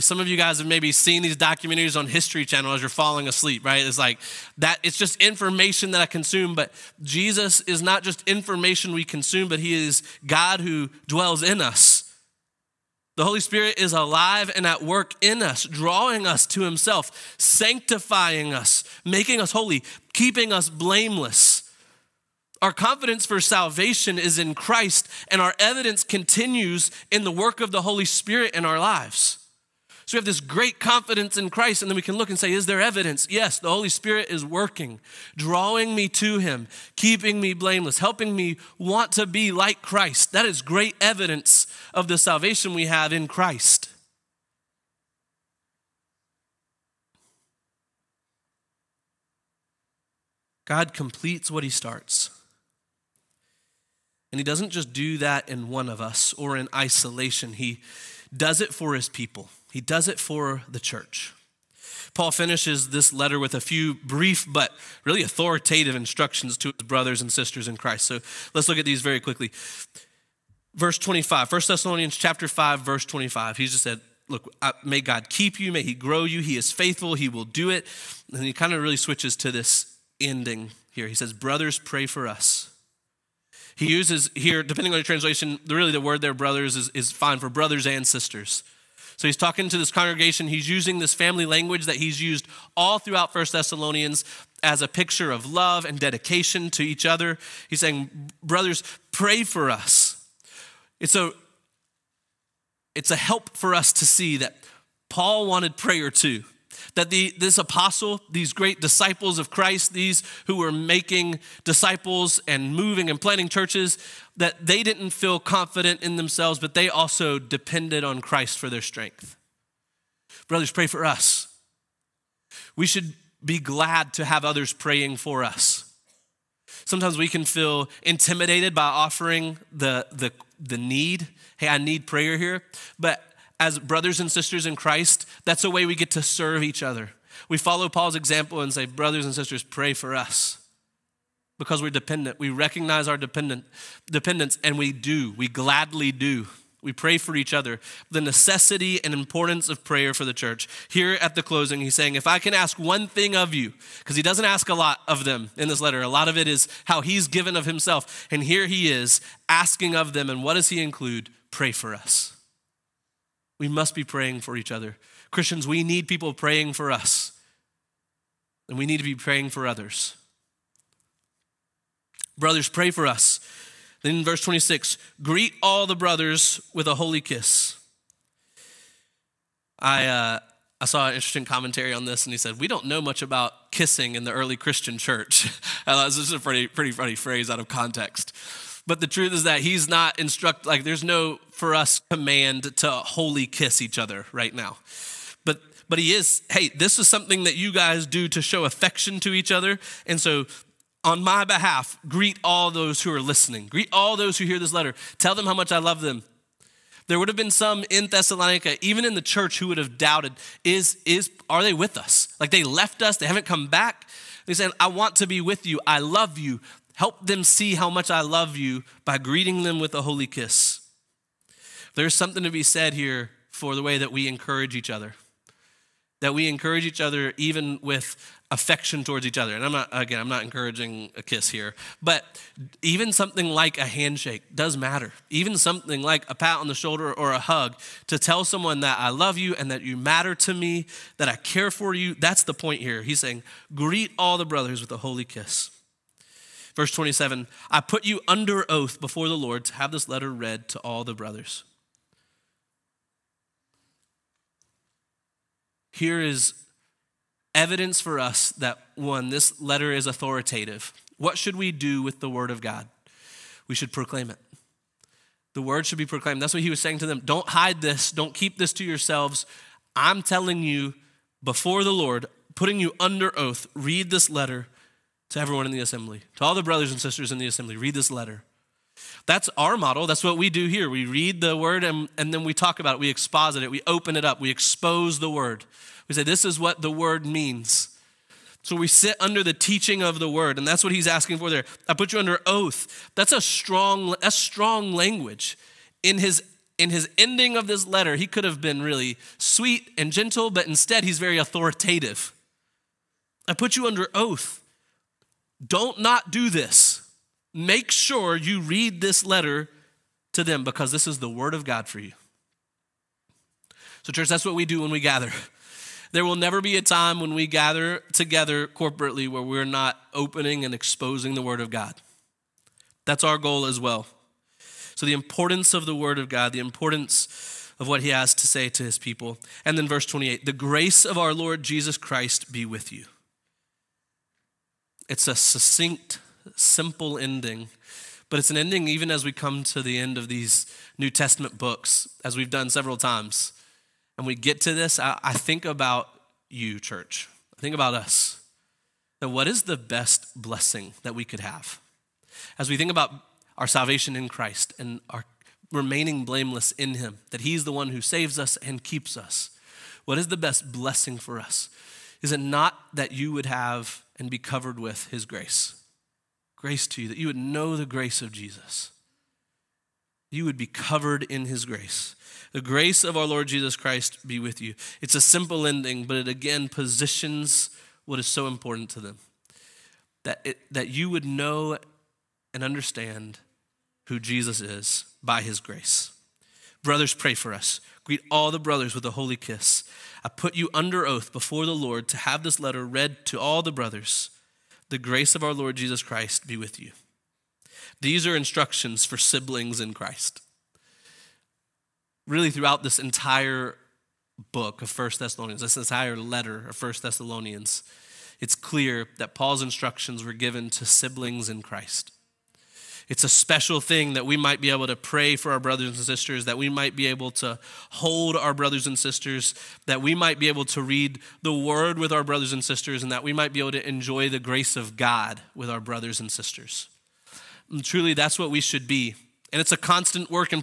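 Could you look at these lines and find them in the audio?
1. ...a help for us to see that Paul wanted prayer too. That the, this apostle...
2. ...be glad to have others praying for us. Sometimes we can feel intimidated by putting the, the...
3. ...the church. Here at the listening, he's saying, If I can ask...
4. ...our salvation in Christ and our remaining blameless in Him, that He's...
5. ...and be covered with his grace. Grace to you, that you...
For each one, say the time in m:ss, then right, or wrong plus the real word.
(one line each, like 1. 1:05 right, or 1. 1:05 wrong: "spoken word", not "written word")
1. 1:43 right
2. 2:03 wrong: "offering", not "putting"
3. 2:30 wrong: "closing", not "listening"
4. 5:53 right
5. 6:04 right.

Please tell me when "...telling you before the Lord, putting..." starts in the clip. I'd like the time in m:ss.
4:30.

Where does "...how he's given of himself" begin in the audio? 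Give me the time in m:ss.
2:36.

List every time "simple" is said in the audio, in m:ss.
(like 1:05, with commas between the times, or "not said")
5:36, 6:15.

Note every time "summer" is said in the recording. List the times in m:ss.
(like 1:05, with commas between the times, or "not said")
not said.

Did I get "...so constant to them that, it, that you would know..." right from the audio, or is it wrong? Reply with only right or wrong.
wrong.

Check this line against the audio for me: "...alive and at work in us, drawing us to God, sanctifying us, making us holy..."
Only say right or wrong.
wrong.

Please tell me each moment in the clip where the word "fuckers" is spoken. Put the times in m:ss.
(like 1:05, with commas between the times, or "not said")
not said.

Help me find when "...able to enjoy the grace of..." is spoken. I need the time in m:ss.
7:03.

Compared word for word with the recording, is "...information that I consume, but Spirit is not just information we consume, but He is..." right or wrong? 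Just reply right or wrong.
wrong.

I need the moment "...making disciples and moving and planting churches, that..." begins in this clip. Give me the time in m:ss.
1:50.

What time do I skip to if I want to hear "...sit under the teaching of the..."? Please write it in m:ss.
4:48.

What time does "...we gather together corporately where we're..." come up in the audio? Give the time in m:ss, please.
5:17.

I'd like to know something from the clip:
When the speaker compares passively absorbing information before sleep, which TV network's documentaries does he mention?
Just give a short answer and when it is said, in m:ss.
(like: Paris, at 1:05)
History Channel, at 0:02.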